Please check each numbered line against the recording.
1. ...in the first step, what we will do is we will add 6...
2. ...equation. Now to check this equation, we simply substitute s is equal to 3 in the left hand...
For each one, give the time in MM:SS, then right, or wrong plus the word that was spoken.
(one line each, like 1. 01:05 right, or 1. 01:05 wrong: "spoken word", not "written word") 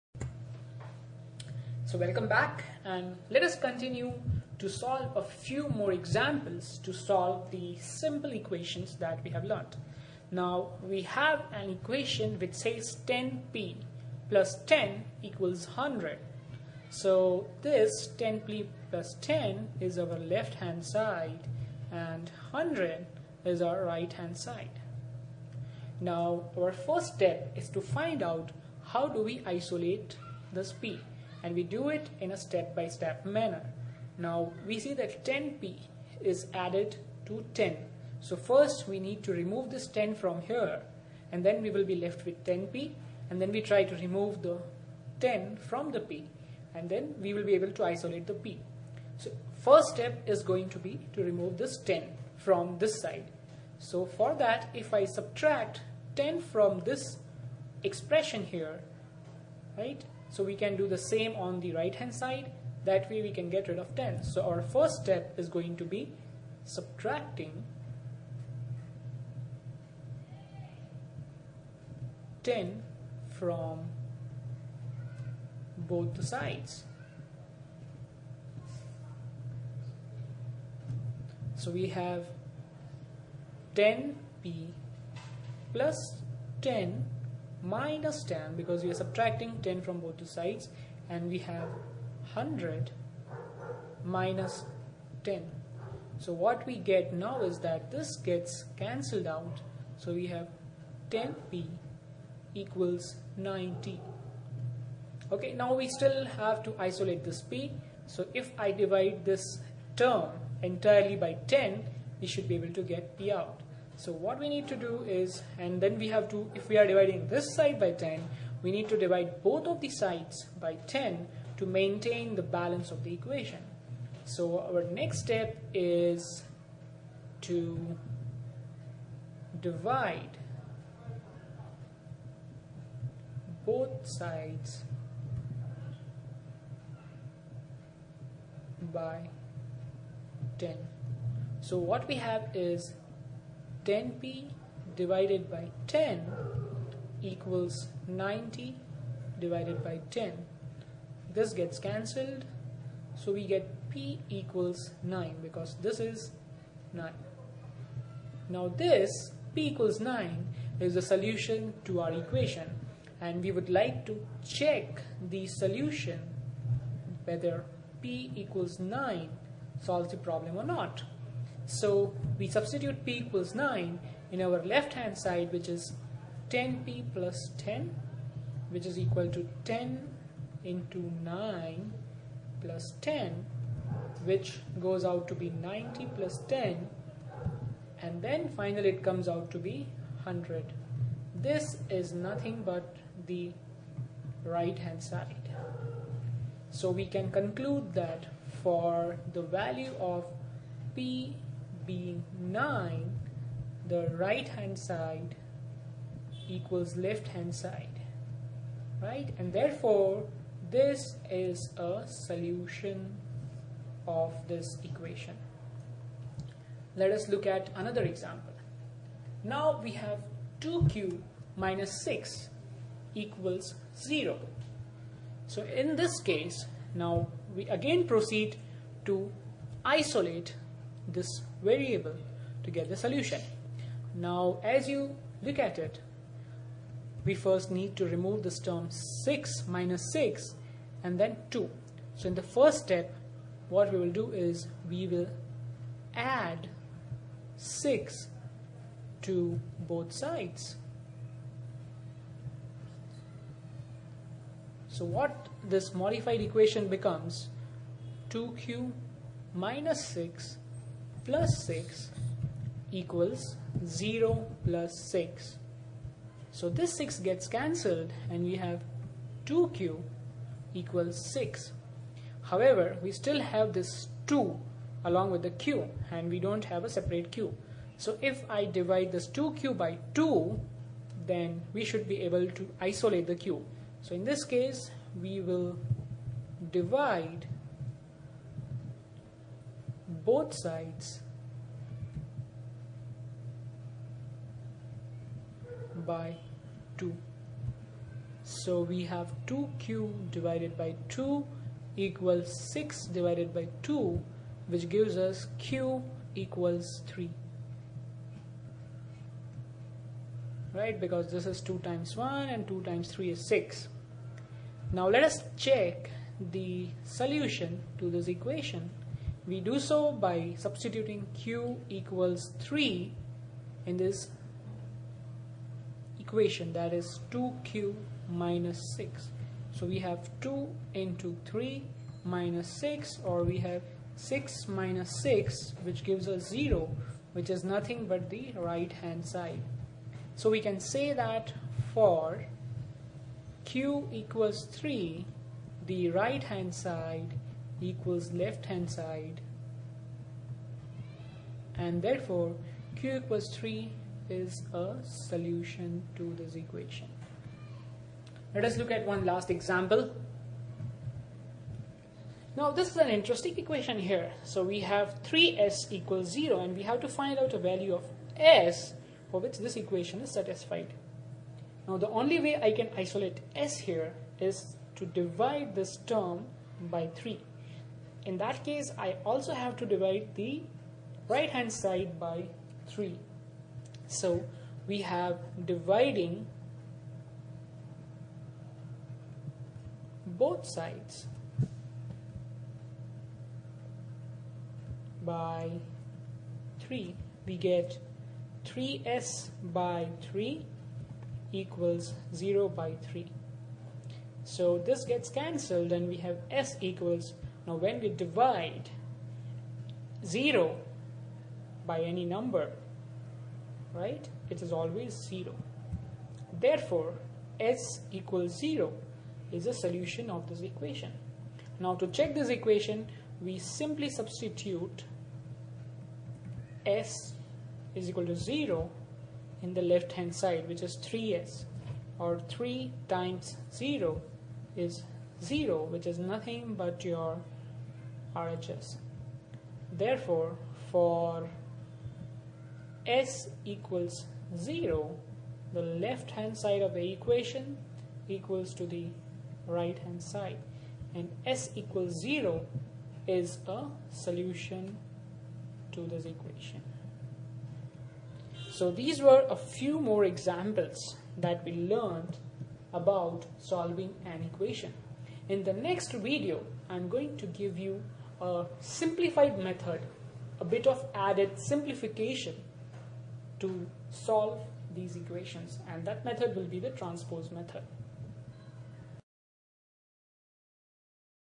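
1. 04:02 right
2. 07:00 wrong: "0", not "3".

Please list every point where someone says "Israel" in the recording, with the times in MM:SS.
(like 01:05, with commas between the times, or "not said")
not said.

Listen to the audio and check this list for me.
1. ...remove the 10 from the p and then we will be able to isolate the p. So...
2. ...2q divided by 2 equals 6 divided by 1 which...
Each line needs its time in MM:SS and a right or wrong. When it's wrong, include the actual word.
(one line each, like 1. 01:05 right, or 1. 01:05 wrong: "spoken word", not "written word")
1. 00:43 right
2. 04:59 wrong: "2", not "1".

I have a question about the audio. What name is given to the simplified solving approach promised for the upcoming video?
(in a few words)
transpose method.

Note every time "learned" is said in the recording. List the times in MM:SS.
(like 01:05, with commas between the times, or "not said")
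00:09, 07:41.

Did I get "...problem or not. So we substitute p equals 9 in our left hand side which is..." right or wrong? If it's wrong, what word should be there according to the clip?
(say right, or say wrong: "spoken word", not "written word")
right.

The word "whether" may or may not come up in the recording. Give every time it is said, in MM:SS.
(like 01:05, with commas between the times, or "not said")
02:47.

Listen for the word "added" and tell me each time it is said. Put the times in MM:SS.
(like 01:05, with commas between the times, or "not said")
00:36, 07:51.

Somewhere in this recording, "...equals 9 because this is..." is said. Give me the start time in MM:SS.
02:34.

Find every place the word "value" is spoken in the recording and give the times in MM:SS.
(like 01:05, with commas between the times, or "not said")
03:19, 06:07.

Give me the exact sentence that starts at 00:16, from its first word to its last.
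So this 10p plus 10 is our left hand side and 100 is our right hand side.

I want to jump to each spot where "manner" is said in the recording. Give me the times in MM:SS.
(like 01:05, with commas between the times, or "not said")
00:33.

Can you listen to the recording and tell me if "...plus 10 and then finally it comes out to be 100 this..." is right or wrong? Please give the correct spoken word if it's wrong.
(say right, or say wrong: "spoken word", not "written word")
right.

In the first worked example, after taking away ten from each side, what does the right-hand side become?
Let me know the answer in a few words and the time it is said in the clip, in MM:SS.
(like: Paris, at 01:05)
90, at 01:41.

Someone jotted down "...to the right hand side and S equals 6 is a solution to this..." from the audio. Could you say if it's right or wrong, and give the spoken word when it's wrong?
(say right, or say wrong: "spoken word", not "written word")
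wrong: "0", not "6".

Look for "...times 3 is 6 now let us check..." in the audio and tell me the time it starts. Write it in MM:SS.
05:12.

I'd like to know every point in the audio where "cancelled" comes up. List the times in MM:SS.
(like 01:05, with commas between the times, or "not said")
01:38, 02:31, 04:27, 06:45.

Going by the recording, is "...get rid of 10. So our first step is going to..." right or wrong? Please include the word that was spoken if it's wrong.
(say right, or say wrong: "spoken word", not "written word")
right.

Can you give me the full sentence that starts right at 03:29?
And therefore, this is a solution of this equation.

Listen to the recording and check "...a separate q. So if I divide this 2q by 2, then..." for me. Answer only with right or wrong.
right.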